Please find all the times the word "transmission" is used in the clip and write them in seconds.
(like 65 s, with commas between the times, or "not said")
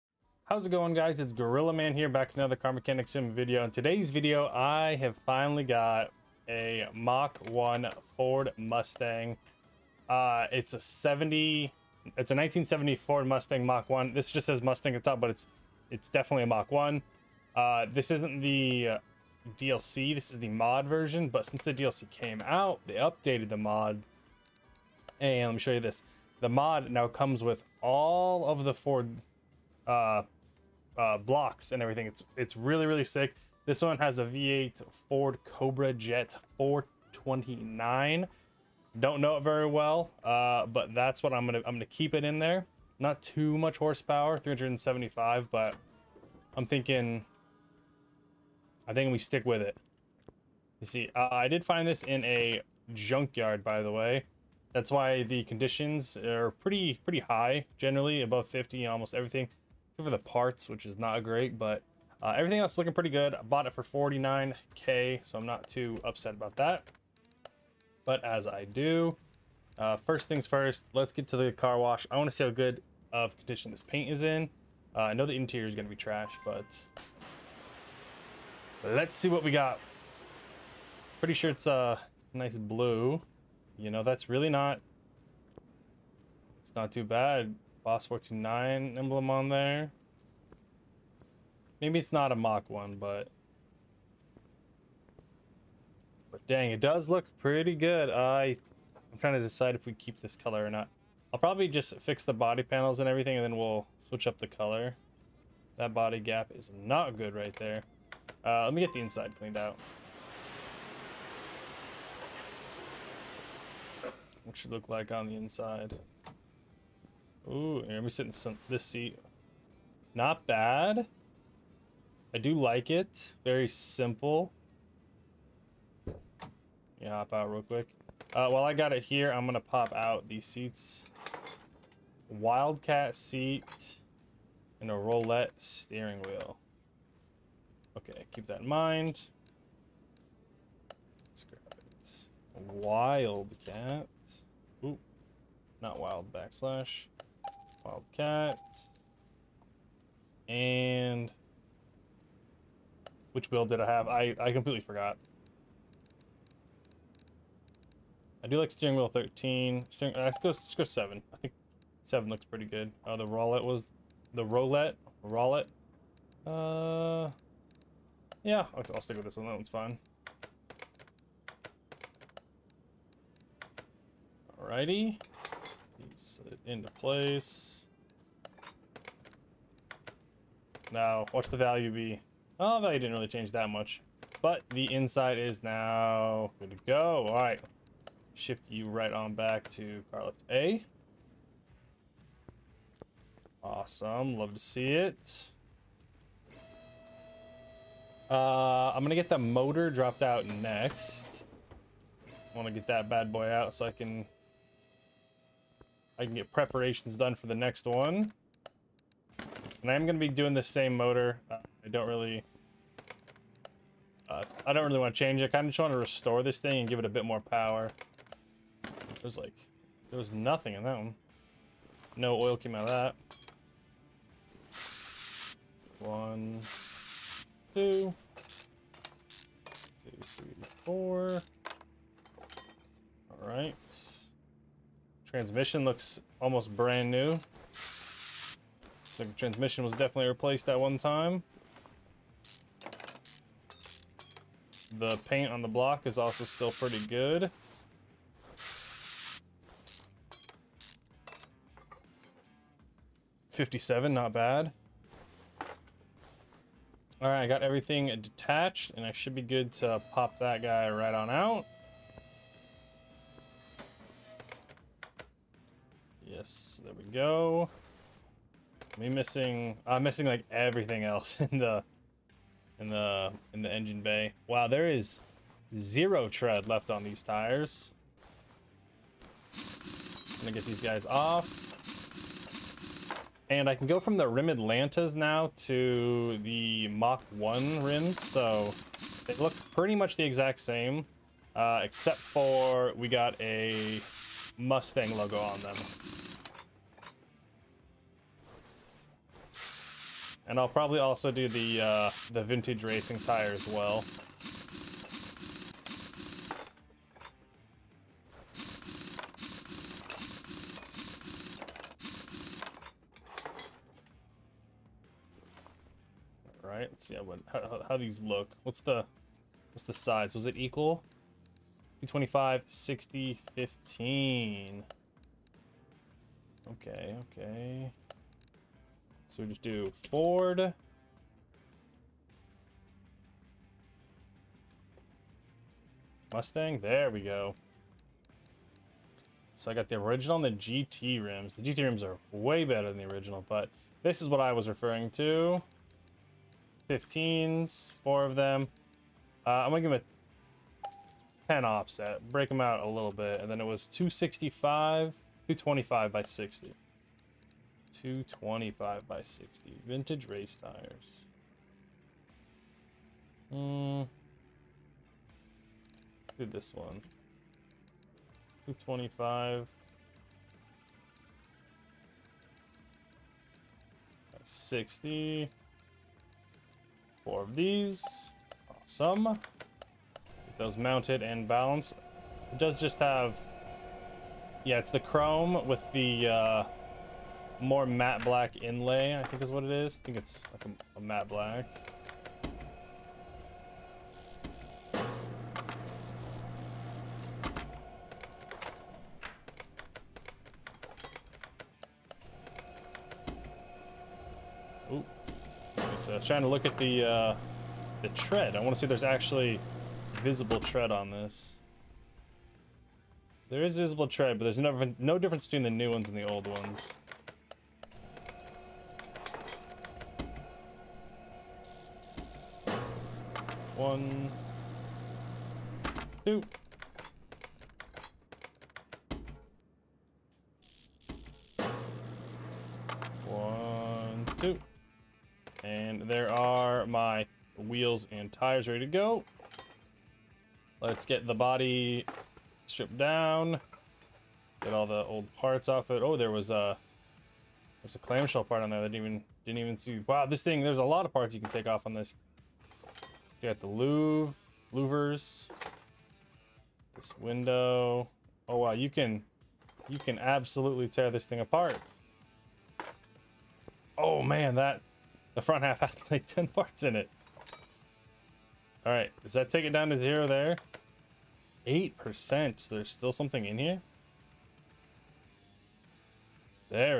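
235 s, 239 s.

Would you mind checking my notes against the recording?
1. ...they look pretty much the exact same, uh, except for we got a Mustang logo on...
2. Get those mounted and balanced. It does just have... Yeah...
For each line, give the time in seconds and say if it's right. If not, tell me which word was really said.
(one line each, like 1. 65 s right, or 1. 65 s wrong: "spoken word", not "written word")
1. 289 s right
2. 379 s right.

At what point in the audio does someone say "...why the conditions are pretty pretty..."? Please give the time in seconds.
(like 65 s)
54 s.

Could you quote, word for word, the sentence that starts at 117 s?
Ooh, you're sit sitting some, this seat.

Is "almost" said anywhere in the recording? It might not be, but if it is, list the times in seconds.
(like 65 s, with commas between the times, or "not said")
58 s, 236 s.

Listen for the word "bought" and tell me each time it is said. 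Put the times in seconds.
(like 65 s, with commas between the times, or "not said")
63 s.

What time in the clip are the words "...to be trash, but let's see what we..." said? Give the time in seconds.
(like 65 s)
75 s.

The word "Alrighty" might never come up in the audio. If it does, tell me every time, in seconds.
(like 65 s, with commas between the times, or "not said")
174 s.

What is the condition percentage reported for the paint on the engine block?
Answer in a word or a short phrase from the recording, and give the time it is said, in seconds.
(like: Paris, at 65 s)
57, at 253 s.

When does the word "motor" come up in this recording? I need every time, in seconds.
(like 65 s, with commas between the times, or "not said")
199 s, 210 s.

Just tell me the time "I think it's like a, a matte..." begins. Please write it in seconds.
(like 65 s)
390 s.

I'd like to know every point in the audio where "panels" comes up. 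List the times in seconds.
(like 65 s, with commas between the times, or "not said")
102 s.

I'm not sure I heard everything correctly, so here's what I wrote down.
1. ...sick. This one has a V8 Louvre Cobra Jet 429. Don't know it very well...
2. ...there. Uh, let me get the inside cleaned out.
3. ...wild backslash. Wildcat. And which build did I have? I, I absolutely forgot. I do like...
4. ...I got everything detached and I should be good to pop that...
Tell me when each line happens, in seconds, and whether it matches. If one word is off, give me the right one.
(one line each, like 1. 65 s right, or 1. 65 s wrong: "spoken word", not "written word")
1. 33 s wrong: "Ford", not "Louvre"
2. 107 s right
3. 145 s wrong: "completely", not "absolutely"
4. 257 s right.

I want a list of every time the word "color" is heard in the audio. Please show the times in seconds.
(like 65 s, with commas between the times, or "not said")
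100 s, 104 s.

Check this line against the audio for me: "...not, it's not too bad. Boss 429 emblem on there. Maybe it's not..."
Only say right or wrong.
right.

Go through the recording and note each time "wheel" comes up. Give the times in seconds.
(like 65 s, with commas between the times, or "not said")
136 s, 158 s, 437 s.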